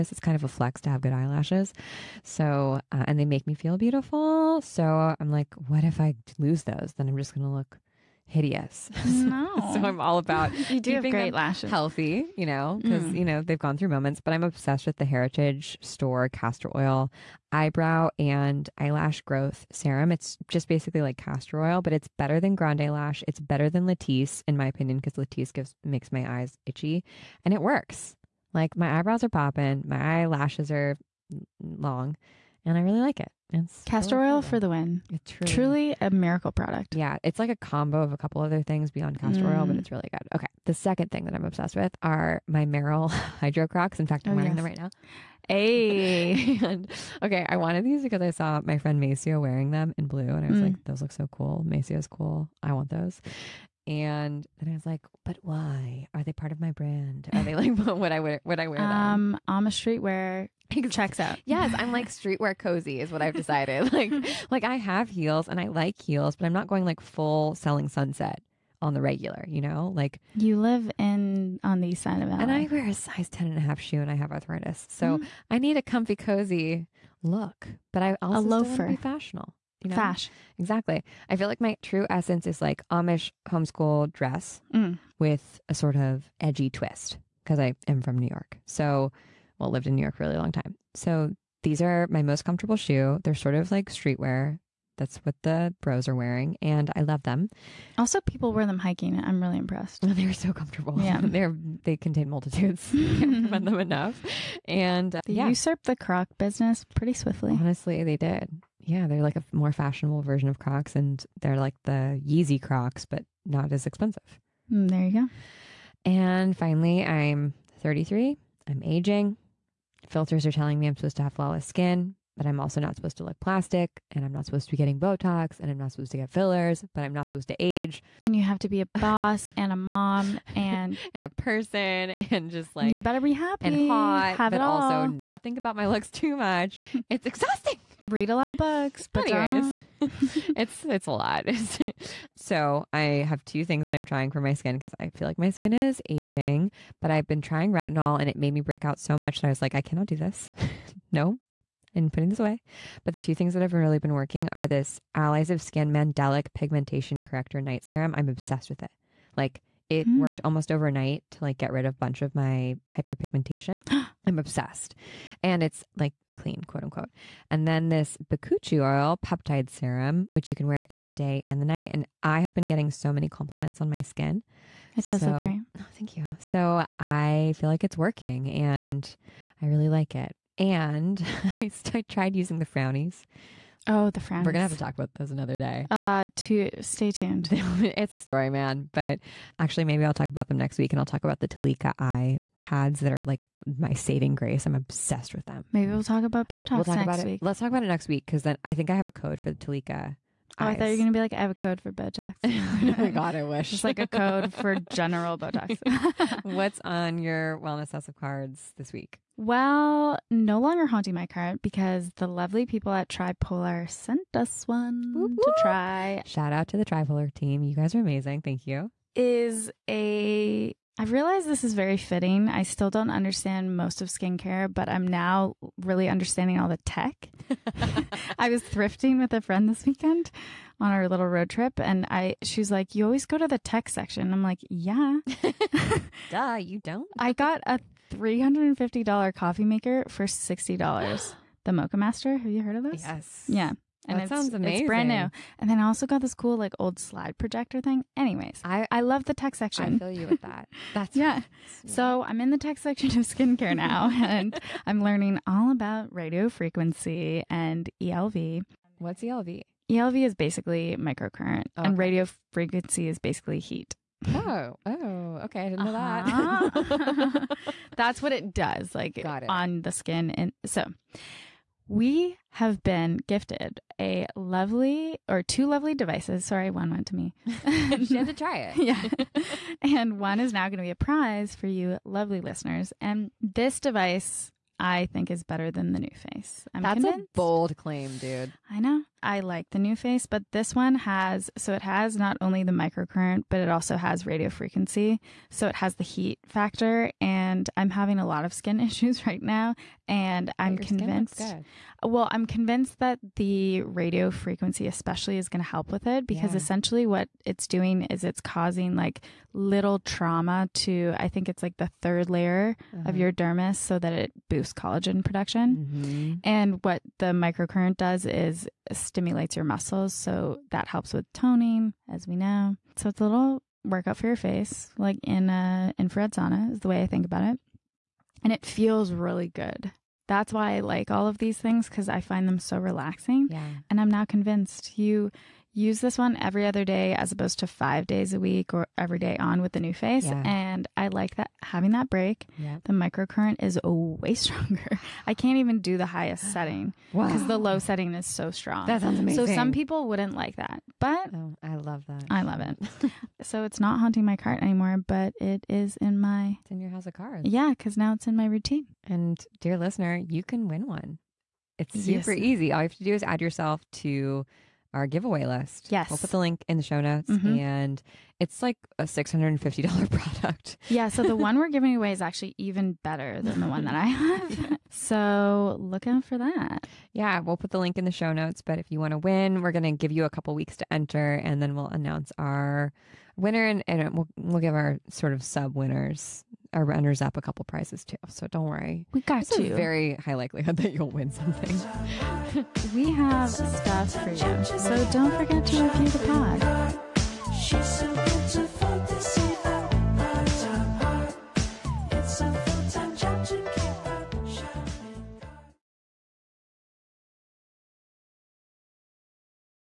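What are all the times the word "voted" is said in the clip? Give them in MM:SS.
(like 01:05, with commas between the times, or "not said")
not said.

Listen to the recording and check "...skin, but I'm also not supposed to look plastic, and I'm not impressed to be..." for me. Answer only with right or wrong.
wrong.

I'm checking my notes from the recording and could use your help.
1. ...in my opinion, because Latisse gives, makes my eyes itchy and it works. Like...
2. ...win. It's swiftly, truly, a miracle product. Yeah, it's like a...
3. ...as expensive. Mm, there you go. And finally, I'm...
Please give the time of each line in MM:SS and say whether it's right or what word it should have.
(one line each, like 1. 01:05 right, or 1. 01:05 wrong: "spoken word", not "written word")
1. 00:24 right
2. 00:34 wrong: "truly", not "swiftly"
3. 01:53 right.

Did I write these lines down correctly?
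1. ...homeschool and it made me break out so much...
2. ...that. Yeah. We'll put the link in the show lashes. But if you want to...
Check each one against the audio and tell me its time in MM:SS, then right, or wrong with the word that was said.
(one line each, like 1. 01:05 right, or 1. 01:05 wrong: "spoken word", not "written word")
1. 02:27 wrong: "retinol", not "homeschool"
2. 06:16 wrong: "notes", not "lashes".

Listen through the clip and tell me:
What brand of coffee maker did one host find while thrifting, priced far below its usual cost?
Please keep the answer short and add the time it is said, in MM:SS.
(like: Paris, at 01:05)
Moccamaster, at 04:01.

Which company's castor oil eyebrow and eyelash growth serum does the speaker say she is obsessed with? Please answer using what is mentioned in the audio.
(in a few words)
Heritage Store.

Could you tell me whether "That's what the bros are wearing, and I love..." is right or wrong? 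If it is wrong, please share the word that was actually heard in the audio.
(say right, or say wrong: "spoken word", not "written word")
right.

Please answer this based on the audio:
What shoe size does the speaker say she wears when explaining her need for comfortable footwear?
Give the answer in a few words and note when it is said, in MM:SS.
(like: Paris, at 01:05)
10 and a half, at 01:13.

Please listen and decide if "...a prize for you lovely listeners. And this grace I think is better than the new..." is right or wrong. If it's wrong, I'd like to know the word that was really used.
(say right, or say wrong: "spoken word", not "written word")
wrong: "device", not "grace".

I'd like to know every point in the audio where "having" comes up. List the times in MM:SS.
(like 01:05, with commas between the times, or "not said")
04:57, 05:41.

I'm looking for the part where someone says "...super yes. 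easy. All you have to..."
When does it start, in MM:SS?
06:02.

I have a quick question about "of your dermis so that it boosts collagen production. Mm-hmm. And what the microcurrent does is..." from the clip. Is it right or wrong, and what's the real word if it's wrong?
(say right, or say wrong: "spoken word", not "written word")
right.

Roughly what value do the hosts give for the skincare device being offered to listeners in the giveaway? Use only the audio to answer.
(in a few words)
$650.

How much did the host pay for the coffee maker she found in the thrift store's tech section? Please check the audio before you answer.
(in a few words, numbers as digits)
$60.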